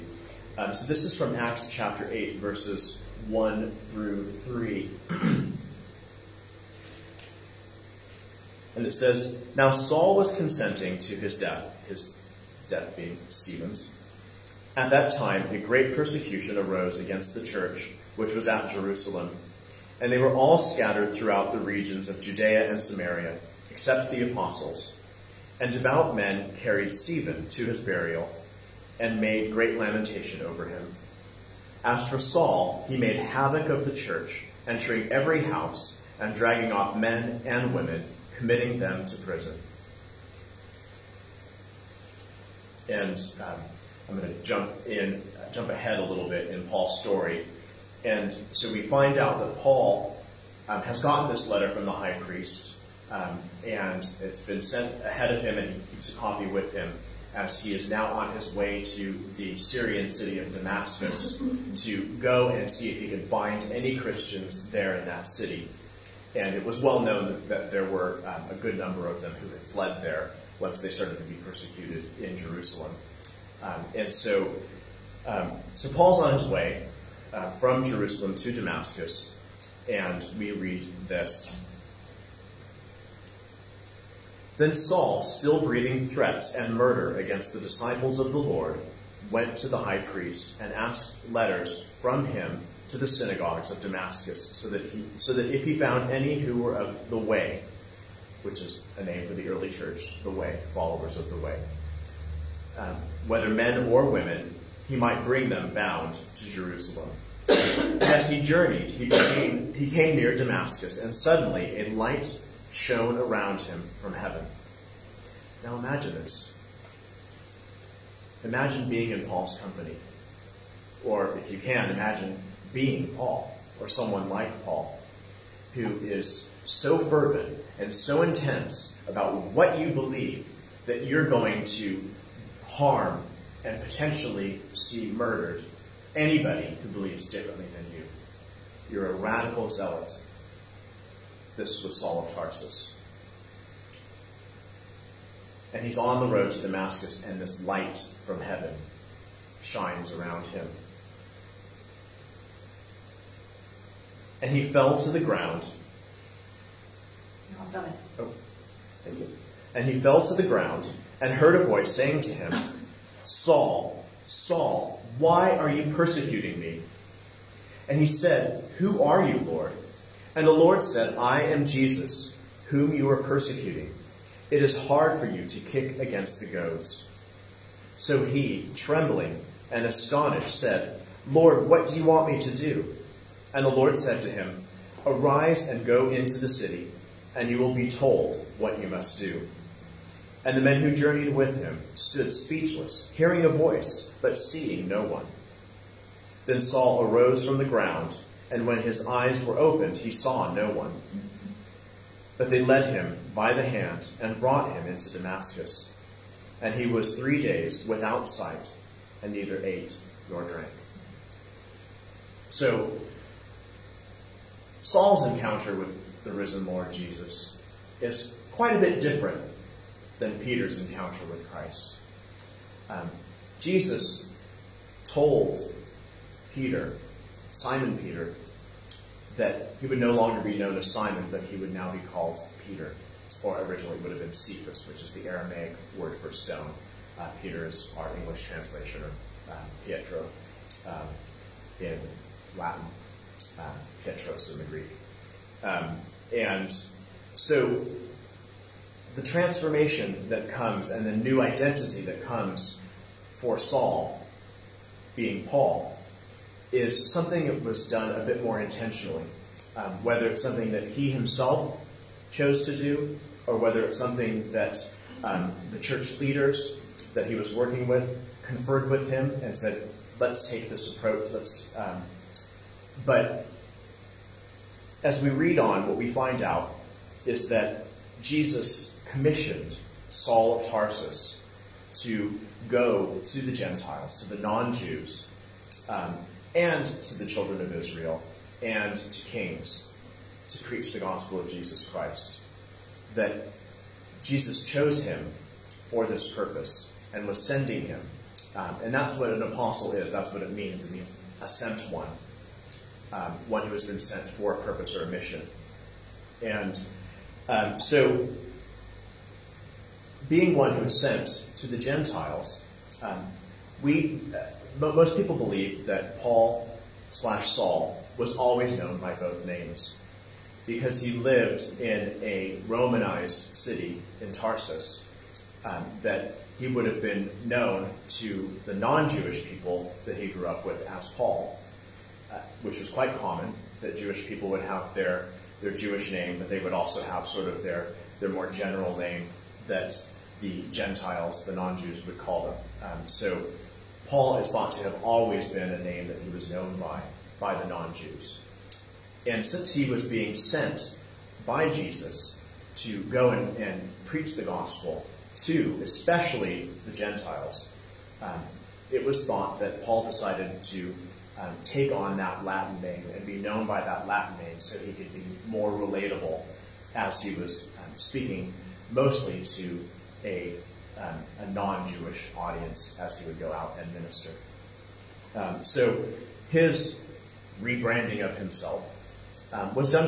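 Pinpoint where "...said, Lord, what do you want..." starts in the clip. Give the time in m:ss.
3:00.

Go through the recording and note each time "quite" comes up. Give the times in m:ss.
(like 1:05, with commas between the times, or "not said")
3:38, 5:32.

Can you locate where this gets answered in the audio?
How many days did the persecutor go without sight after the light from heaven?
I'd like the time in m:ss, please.
3:27.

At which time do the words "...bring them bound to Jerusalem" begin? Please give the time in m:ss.
1:45.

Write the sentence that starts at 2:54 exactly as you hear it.
It is hard for you to kick against the goads.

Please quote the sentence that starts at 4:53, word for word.
That Jesus chose him for this purpose and was sending him.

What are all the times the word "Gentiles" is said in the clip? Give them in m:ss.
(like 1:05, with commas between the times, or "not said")
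4:43, 5:11, 5:40, 5:56.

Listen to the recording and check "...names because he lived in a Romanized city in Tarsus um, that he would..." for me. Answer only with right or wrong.
right.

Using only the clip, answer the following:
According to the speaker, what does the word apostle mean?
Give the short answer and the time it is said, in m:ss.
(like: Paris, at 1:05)
A sent one, at 5:01.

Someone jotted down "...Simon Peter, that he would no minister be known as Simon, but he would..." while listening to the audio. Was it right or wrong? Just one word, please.
wrong.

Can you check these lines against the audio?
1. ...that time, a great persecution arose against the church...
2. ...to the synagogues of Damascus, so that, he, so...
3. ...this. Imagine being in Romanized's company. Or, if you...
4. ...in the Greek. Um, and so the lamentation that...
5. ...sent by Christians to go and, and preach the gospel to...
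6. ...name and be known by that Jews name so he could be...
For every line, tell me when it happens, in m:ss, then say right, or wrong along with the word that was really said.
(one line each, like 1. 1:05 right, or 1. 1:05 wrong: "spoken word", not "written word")
1. 0:14 right
2. 1:32 right
3. 1:56 wrong: "Paul", not "Romanized"
4. 4:04 wrong: "transformation", not "lamentation"
5. 5:50 wrong: "Jesus", not "Christians"
6. 6:02 wrong: "Latin", not "Jews".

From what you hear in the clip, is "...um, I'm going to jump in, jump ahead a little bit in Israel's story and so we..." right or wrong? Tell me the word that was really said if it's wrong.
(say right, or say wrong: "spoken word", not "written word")
wrong: "Paul", not "Israel".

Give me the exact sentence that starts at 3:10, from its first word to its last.
And the men who journeyed with him stood speechless, hearing a voice, but seeing no one.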